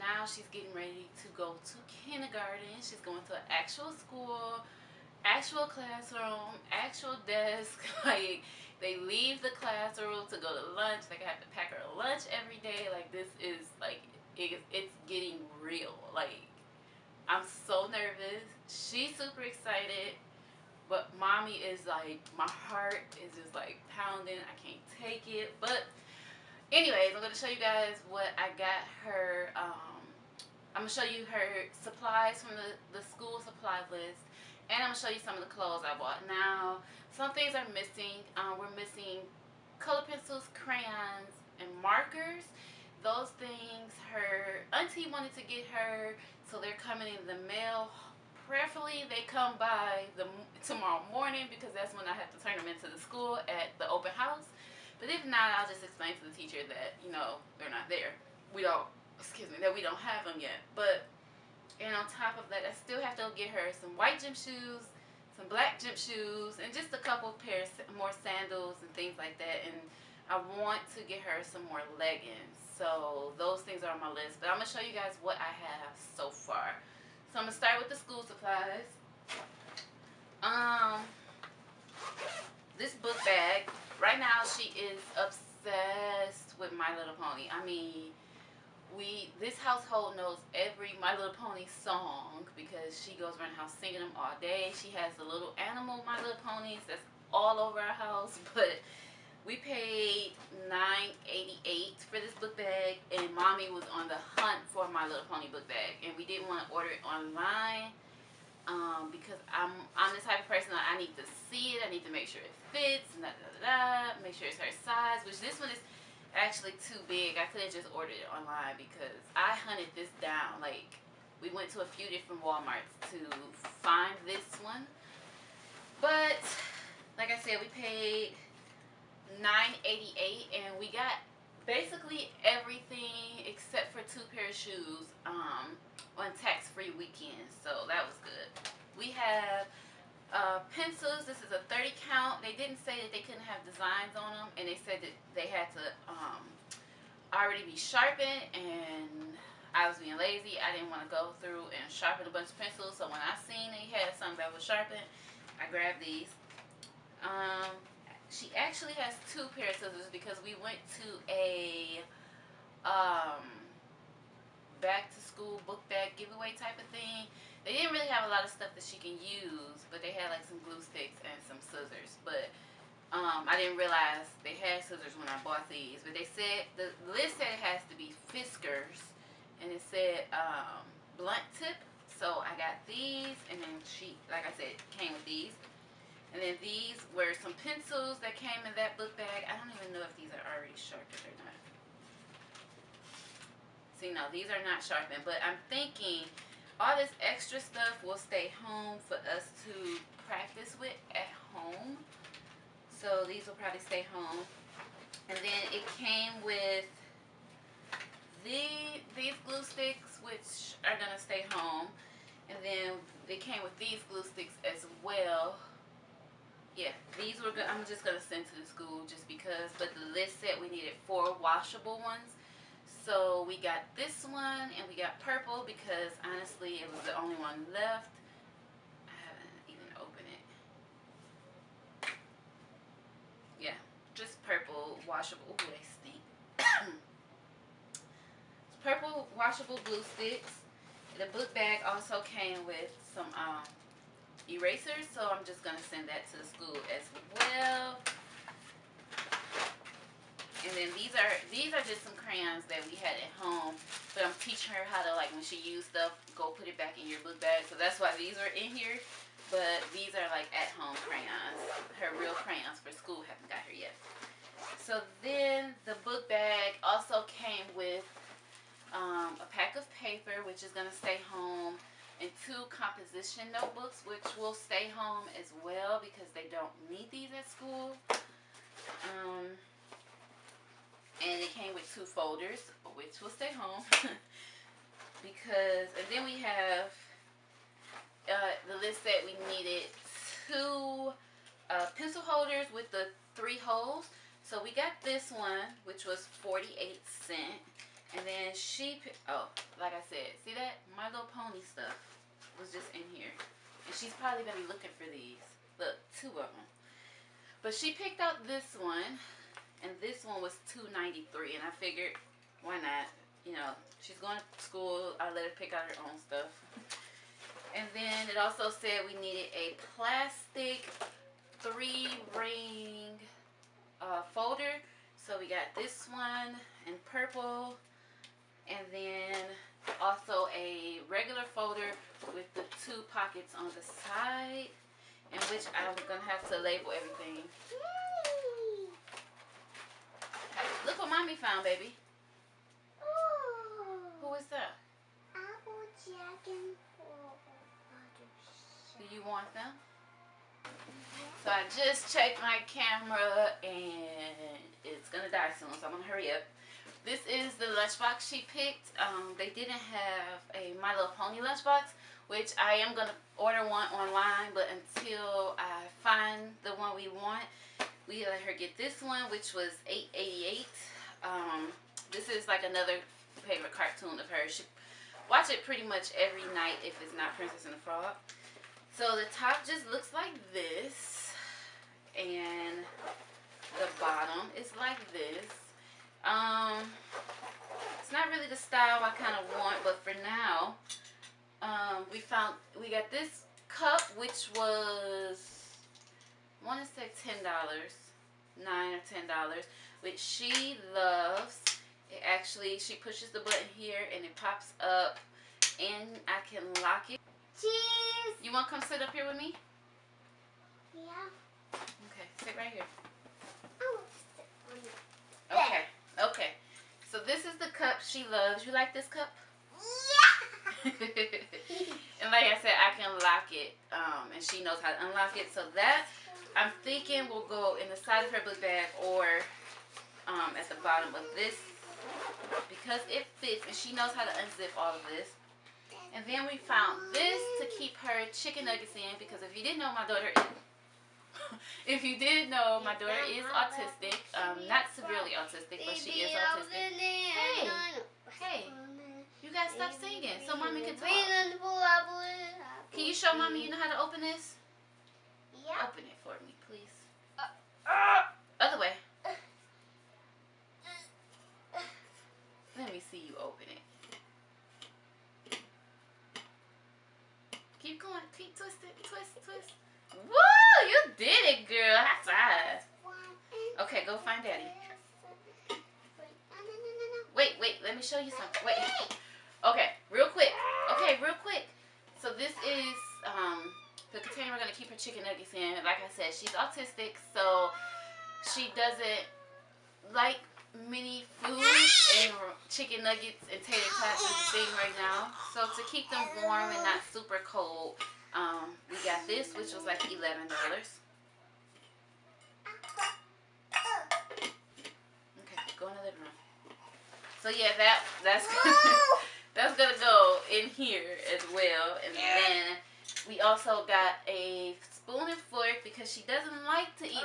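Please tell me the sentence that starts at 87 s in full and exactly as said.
I mean, we this household knows every My Little Pony song because she goes around the house singing them all day.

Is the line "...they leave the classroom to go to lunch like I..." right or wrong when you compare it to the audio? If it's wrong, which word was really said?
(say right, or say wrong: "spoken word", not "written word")
right.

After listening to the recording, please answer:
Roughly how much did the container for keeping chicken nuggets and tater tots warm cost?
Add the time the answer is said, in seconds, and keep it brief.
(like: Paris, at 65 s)
$11, at 500 s.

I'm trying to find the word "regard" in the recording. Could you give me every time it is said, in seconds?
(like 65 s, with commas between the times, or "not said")
not said.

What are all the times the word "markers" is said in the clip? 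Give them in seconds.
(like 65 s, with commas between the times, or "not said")
41 s.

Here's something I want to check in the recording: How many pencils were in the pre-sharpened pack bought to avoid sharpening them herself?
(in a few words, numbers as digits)
30.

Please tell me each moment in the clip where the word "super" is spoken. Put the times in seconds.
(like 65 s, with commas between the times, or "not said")
19 s, 497 s.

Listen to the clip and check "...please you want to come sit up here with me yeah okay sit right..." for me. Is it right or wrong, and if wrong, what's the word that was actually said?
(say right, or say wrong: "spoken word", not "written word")
wrong: "cheese", not "please".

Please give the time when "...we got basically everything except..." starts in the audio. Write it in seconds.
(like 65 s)
130 s.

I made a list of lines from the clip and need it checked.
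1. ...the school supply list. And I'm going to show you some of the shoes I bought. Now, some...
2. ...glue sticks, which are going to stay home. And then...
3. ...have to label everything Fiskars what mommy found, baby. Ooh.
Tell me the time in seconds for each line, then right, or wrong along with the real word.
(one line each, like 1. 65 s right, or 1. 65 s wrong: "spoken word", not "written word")
1. 32 s wrong: "clothes", not "shoes"
2. 209 s right
3. 336 s wrong: "Look", not "Fiskars".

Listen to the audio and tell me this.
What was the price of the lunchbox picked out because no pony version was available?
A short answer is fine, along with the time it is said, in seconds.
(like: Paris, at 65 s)
$8.88, at 369 s.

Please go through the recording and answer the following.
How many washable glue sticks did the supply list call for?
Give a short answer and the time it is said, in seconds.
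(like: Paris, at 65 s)
4, at 221 s.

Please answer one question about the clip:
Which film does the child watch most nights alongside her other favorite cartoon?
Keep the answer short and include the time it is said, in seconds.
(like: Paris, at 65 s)
Princess and the Frog, at 377 s.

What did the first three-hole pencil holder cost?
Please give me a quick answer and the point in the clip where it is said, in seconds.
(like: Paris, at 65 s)
48 cents, at 296 s.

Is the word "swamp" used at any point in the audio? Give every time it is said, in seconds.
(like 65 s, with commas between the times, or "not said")
not said.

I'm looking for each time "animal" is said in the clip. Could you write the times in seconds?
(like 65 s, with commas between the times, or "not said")
95 s.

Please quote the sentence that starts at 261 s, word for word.
Her real crayons for school haven't got here yet.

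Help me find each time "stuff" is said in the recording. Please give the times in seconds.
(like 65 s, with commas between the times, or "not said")
168 s, 197 s, 255 s, 301 s, 316 s.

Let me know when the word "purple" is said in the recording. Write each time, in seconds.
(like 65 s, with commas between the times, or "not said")
225 s, 234 s, 238 s, 327 s.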